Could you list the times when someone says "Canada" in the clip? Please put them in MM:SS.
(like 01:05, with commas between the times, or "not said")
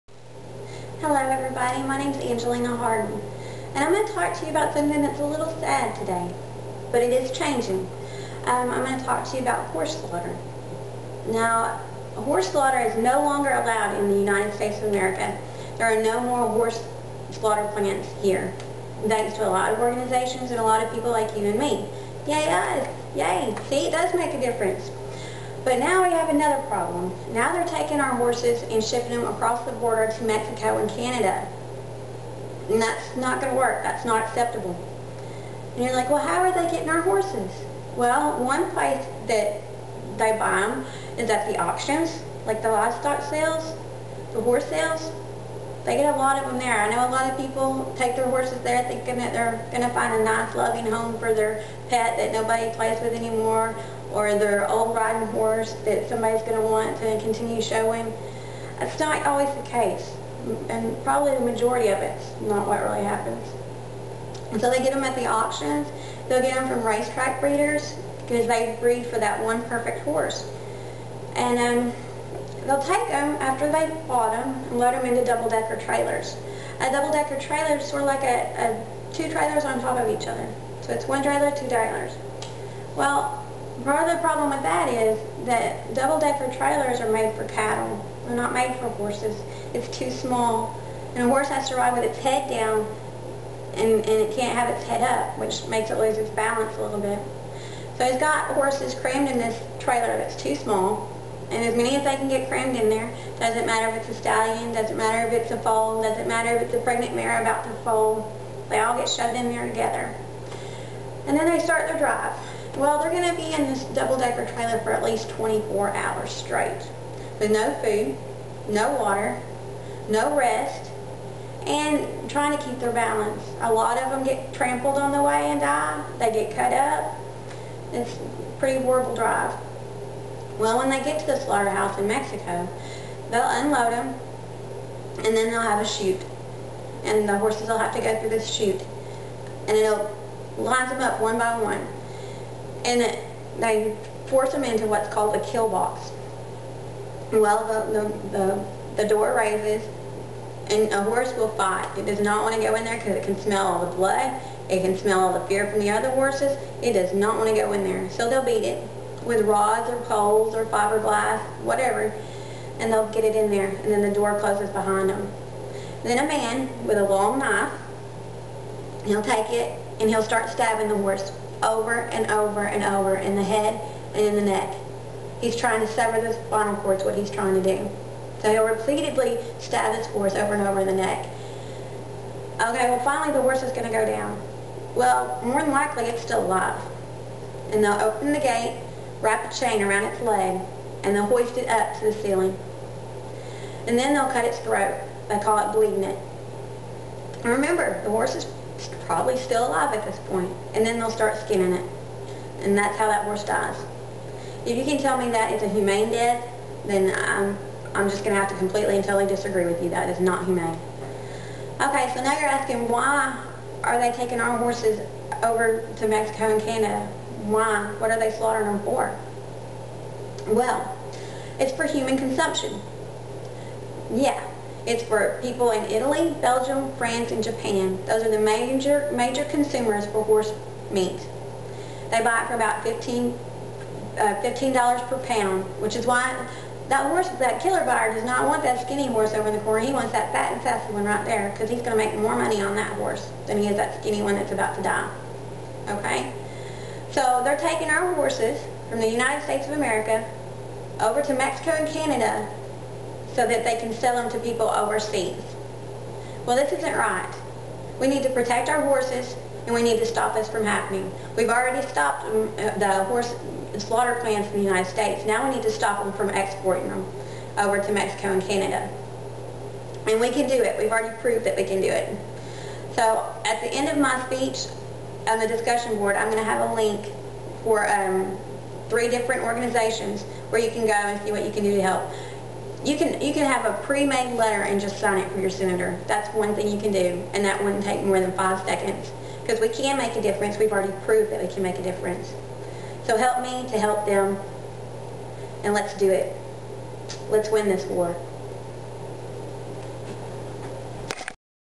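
00:30, 03:36, 04:11, 04:28.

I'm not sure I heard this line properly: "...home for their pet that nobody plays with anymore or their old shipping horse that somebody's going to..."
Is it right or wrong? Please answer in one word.
wrong.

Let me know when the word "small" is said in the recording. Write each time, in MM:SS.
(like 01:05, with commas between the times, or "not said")
01:30, 01:40.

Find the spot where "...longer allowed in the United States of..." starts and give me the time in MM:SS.
00:13.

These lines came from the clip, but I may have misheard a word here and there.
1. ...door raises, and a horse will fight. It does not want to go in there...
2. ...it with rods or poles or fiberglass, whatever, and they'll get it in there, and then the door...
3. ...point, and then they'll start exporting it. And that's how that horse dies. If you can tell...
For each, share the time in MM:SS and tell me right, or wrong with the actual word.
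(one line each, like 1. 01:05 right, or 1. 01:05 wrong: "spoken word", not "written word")
1. 02:29 right
2. 02:38 right
3. 03:20 wrong: "skinning", not "exporting".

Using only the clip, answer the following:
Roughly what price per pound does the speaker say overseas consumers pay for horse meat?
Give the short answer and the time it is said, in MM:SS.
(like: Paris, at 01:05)
$15, at 03:54.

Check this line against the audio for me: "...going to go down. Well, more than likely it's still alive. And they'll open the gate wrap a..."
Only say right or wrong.
right.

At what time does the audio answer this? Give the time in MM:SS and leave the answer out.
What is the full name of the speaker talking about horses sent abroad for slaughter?
00:02.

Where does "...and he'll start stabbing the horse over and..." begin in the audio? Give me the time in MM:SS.
02:49.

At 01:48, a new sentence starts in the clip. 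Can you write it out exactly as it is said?
They all get shoved in there together.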